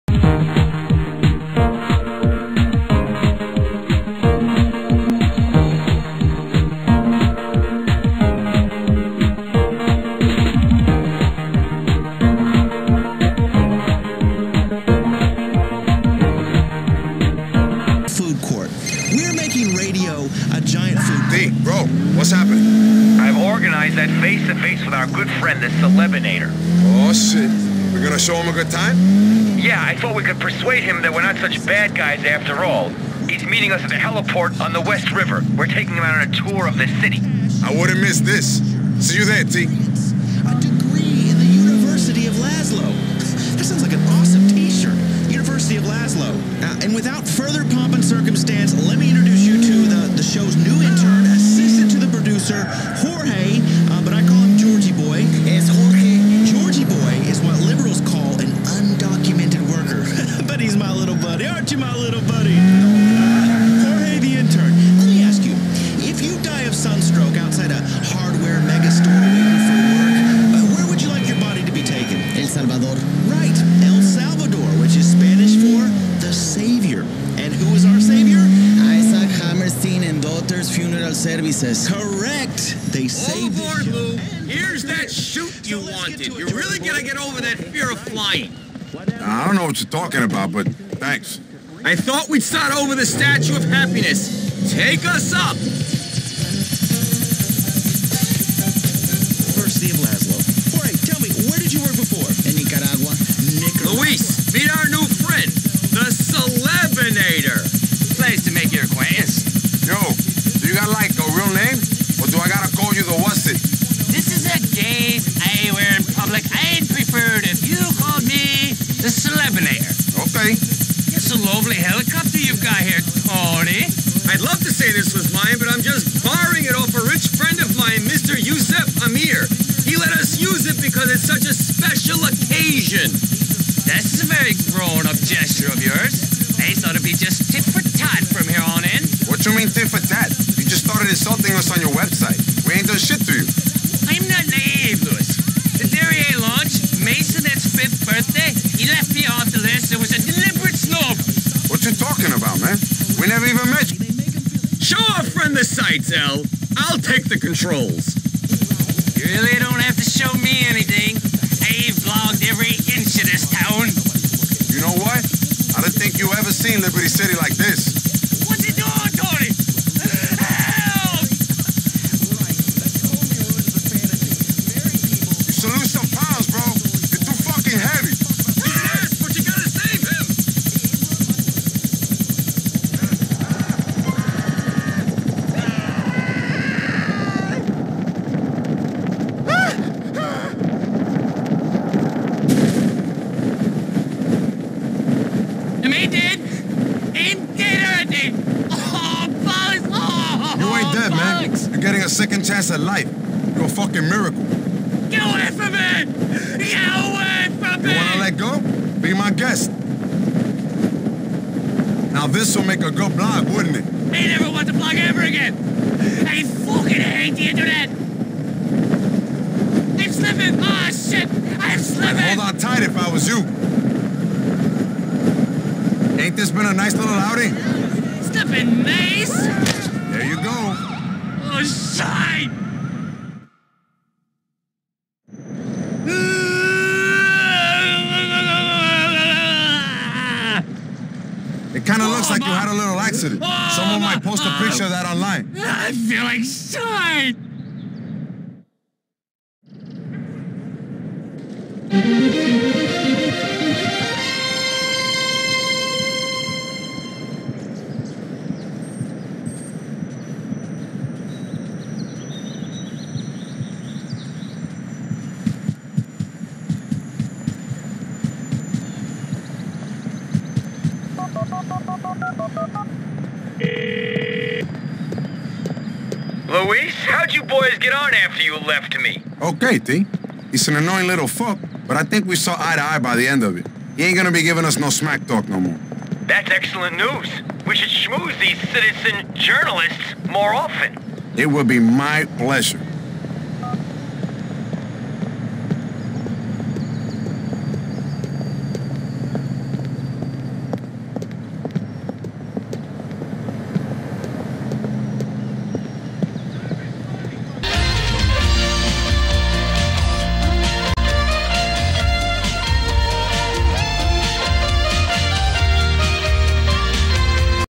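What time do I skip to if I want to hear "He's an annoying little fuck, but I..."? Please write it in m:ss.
4:40.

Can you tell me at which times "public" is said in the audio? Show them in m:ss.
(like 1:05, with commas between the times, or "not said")
1:56.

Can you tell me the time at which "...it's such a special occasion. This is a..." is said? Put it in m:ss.
2:11.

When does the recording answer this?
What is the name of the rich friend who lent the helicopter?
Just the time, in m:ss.
2:08.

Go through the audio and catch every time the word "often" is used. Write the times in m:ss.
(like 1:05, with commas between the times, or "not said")
4:50.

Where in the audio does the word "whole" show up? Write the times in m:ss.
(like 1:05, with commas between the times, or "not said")
not said.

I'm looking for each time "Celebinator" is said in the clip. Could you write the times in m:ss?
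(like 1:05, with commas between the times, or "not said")
0:25, 1:59.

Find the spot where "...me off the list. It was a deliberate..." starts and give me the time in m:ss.
2:29.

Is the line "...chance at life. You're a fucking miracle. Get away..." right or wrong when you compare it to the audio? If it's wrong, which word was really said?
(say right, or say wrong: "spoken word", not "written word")
right.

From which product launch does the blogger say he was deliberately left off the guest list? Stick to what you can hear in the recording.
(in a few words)
The Derriere launch.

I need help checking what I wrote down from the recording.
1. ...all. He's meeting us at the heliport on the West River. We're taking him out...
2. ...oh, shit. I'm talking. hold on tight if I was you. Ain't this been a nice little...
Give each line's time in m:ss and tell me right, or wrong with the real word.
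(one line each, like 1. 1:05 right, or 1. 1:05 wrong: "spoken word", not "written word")
1. 0:32 right
2. 3:40 wrong: "slipping", not "talking".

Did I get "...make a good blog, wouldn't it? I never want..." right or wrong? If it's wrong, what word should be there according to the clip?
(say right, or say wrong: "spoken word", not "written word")
right.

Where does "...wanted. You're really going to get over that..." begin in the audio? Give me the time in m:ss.
1:25.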